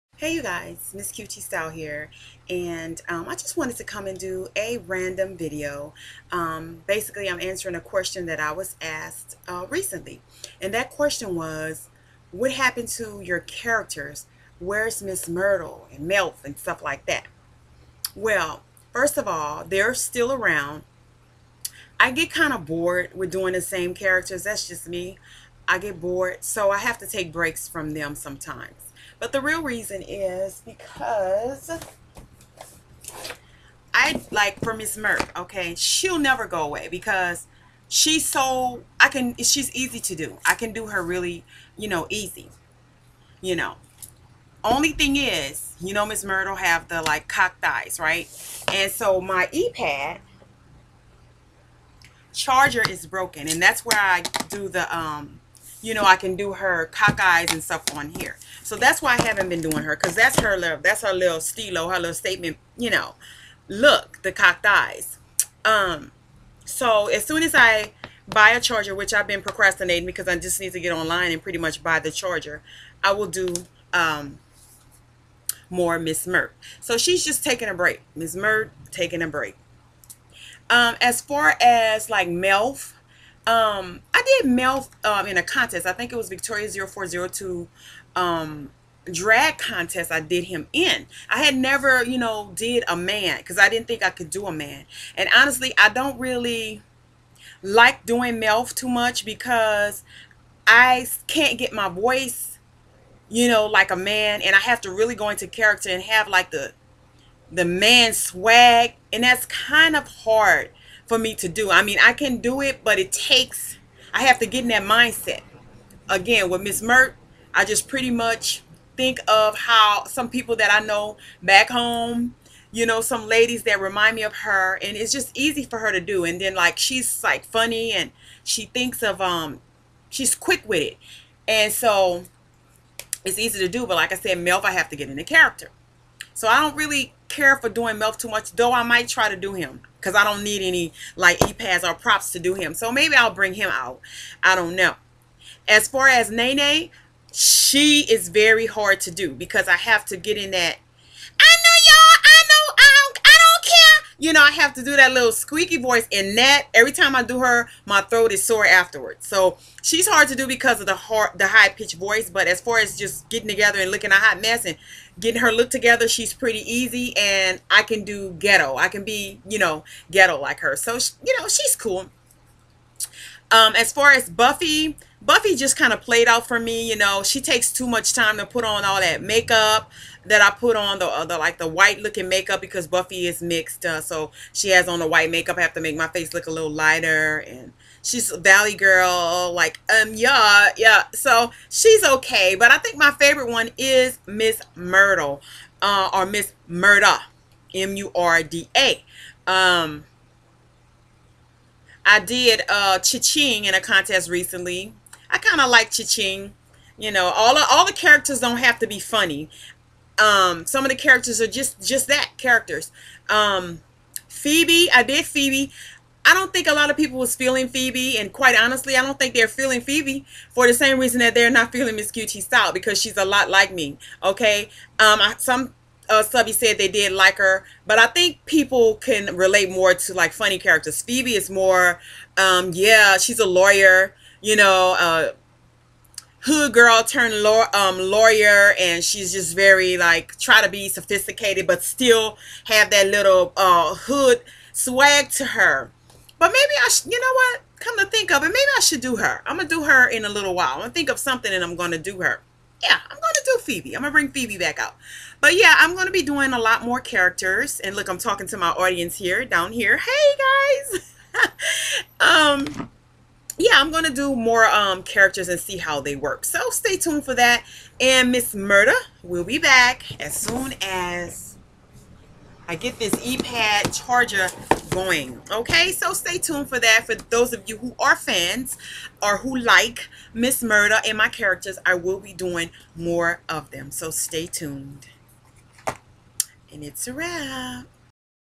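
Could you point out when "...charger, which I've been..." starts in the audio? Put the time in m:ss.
1:08.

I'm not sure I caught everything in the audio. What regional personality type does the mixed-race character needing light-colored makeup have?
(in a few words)
Valley girl.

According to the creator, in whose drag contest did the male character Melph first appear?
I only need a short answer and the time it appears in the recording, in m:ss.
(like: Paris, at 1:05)
Victoria 0402, at 1:26.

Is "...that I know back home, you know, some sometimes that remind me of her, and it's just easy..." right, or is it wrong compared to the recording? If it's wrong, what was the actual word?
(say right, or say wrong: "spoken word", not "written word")
wrong: "ladies", not "sometimes".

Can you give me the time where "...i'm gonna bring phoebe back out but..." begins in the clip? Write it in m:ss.
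4:13.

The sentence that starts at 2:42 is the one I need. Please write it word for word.
But as far as just getting together and looking a hot mess and getting her look together, she's pretty easy.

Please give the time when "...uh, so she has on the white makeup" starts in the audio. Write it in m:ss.
3:03.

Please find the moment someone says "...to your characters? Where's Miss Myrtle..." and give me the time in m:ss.
0:12.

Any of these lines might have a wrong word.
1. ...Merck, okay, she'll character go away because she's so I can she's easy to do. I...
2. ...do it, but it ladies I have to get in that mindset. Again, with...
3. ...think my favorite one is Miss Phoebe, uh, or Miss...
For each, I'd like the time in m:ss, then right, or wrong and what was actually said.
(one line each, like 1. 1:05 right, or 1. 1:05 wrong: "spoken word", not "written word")
1. 0:34 wrong: "never", not "character"
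2. 1:52 wrong: "takes", not "ladies"
3. 3:12 wrong: "Myrtle", not "Phoebe".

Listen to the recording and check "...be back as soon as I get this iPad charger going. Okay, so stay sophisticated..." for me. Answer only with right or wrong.
wrong.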